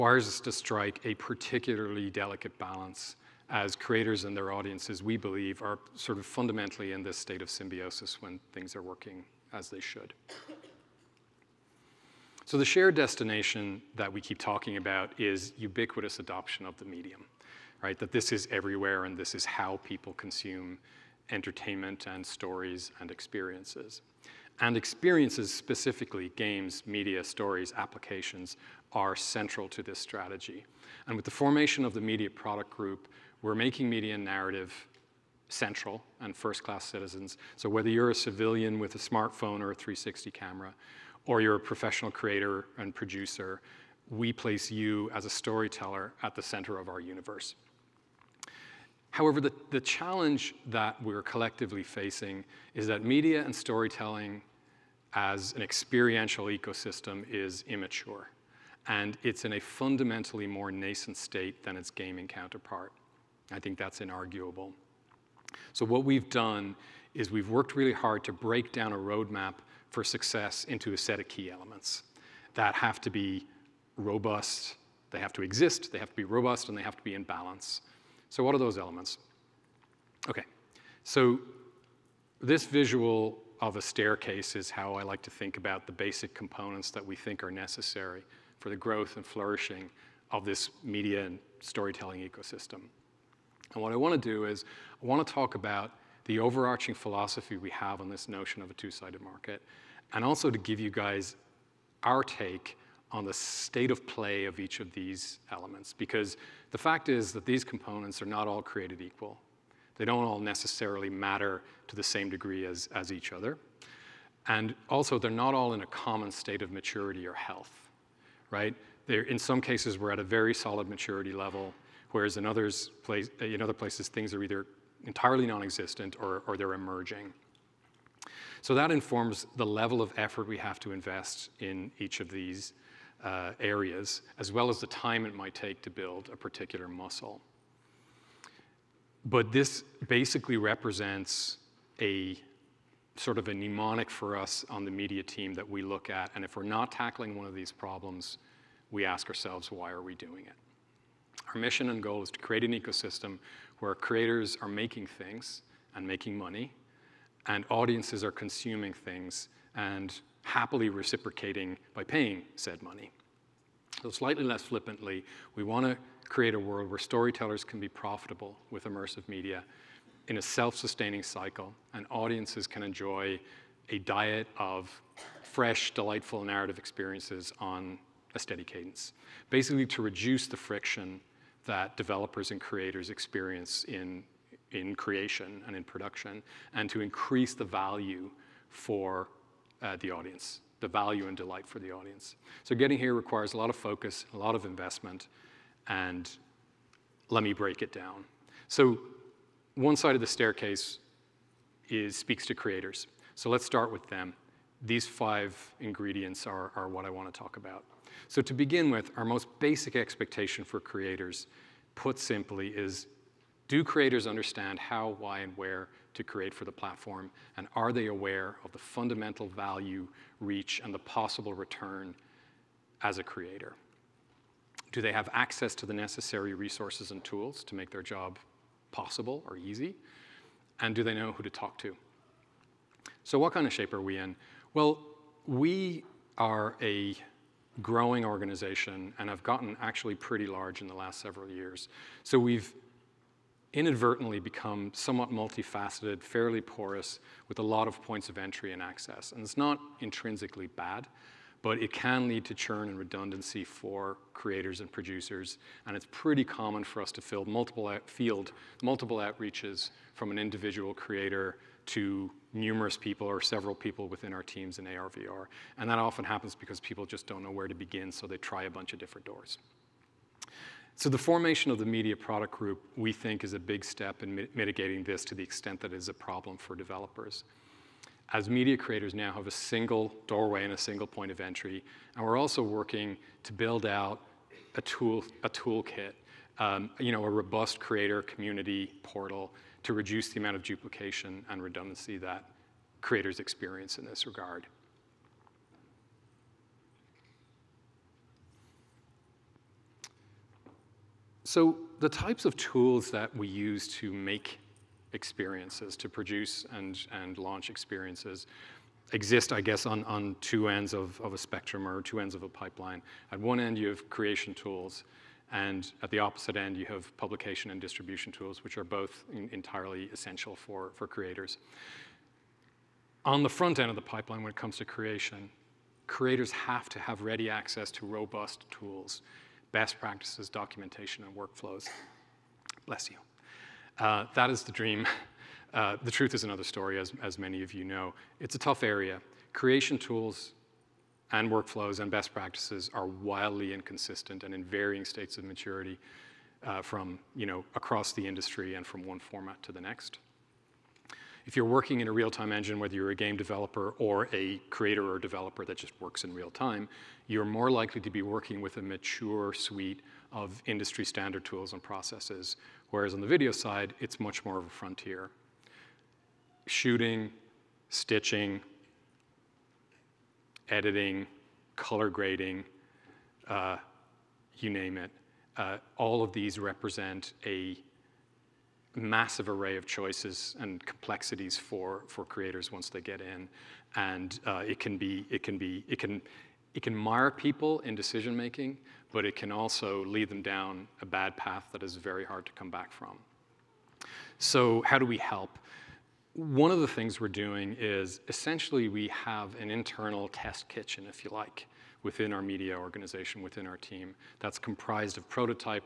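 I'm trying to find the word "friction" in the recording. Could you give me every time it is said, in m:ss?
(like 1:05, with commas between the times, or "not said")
3:00.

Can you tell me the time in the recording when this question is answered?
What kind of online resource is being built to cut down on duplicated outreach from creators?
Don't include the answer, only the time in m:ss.
4:47.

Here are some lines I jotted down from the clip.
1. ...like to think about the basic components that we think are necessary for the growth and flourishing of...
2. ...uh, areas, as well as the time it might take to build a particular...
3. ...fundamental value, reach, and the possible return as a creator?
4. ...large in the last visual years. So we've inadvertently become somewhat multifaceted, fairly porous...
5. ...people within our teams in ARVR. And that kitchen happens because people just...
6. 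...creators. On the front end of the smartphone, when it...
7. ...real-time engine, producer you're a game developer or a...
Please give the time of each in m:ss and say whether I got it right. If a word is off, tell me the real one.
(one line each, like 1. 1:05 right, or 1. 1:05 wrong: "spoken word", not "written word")
1. 1:25 right
2. 2:13 right
3. 3:38 right
4. 4:00 wrong: "several", not "visual"
5. 4:23 wrong: "often", not "kitchen"
6. 5:21 wrong: "pipeline", not "smartphone"
7. 5:52 wrong: "whether", not "producer".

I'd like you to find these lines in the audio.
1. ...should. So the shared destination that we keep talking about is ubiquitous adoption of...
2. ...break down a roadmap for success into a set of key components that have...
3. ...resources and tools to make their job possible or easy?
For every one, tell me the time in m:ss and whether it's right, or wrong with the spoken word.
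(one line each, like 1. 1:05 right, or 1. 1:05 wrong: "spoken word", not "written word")
1. 0:09 right
2. 1:08 wrong: "elements", not "components"
3. 3:46 right.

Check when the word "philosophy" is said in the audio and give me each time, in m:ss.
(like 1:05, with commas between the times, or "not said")
1:36.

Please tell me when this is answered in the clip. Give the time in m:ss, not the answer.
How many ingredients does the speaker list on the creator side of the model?
3:25.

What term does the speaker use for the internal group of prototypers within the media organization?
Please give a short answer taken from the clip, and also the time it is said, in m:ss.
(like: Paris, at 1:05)
test kitchen, at 6:40.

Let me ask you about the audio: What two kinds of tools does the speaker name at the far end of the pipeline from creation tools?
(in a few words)
publication and distribution.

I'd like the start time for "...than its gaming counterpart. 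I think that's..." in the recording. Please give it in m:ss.
1:01.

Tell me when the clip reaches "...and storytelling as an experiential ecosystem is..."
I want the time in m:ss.
0:53.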